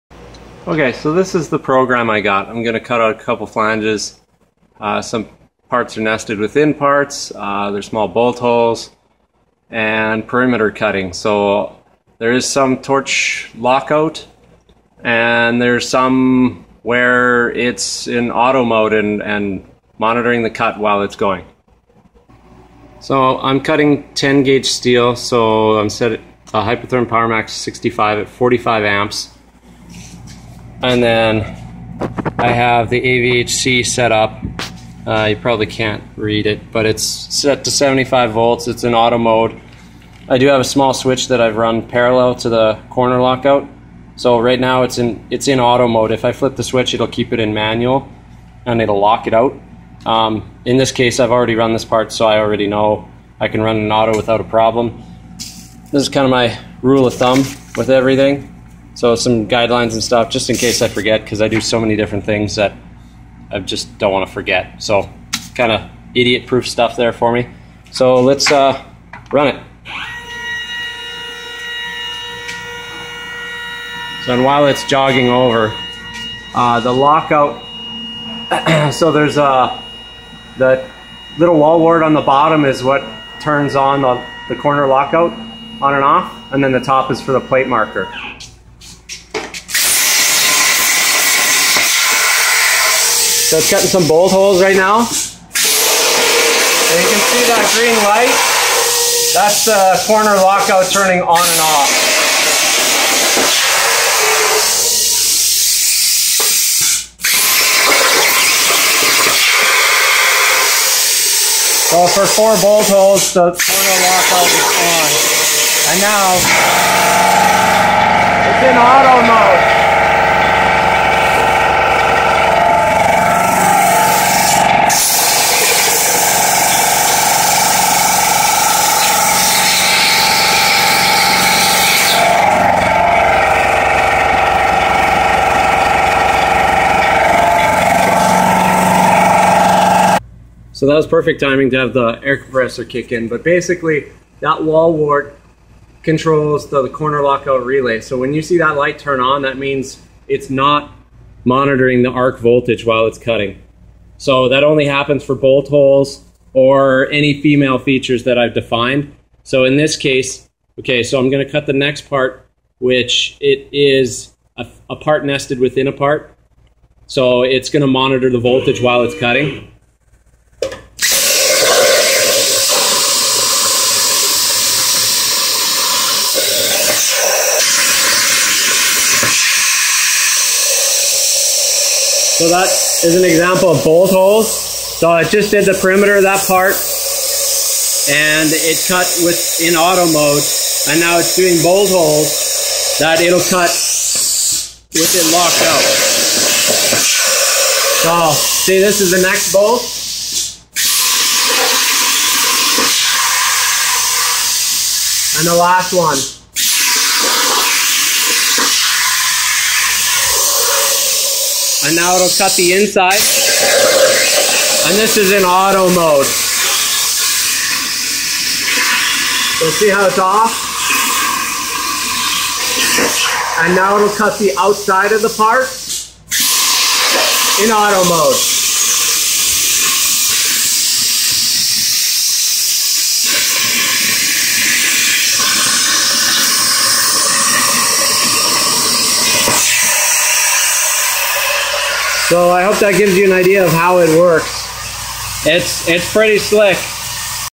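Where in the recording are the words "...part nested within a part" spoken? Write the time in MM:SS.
02:44.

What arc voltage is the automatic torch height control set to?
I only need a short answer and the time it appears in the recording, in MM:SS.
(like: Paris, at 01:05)
75 volts, at 00:37.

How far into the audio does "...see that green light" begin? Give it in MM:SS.
01:37.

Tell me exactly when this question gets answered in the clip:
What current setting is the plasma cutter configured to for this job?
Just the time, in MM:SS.
00:28.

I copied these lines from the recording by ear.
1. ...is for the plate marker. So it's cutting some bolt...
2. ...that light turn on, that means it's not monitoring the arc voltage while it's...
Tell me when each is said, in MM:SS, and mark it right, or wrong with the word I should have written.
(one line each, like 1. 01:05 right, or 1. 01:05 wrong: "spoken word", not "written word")
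1. 01:27 right
2. 02:28 right.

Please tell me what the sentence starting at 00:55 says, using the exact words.
This is kind of my rule of thumb with everything.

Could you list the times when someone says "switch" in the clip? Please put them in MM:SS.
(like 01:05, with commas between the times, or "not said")
00:40, 00:46.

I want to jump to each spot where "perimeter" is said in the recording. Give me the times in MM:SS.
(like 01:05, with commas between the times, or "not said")
00:10, 03:05.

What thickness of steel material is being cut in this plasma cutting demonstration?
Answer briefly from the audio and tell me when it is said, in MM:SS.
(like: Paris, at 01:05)
10 gauge, at 00:24.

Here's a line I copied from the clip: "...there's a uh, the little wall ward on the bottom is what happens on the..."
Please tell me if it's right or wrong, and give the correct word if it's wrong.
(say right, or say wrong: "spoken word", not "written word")
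wrong: "turns", not "happens".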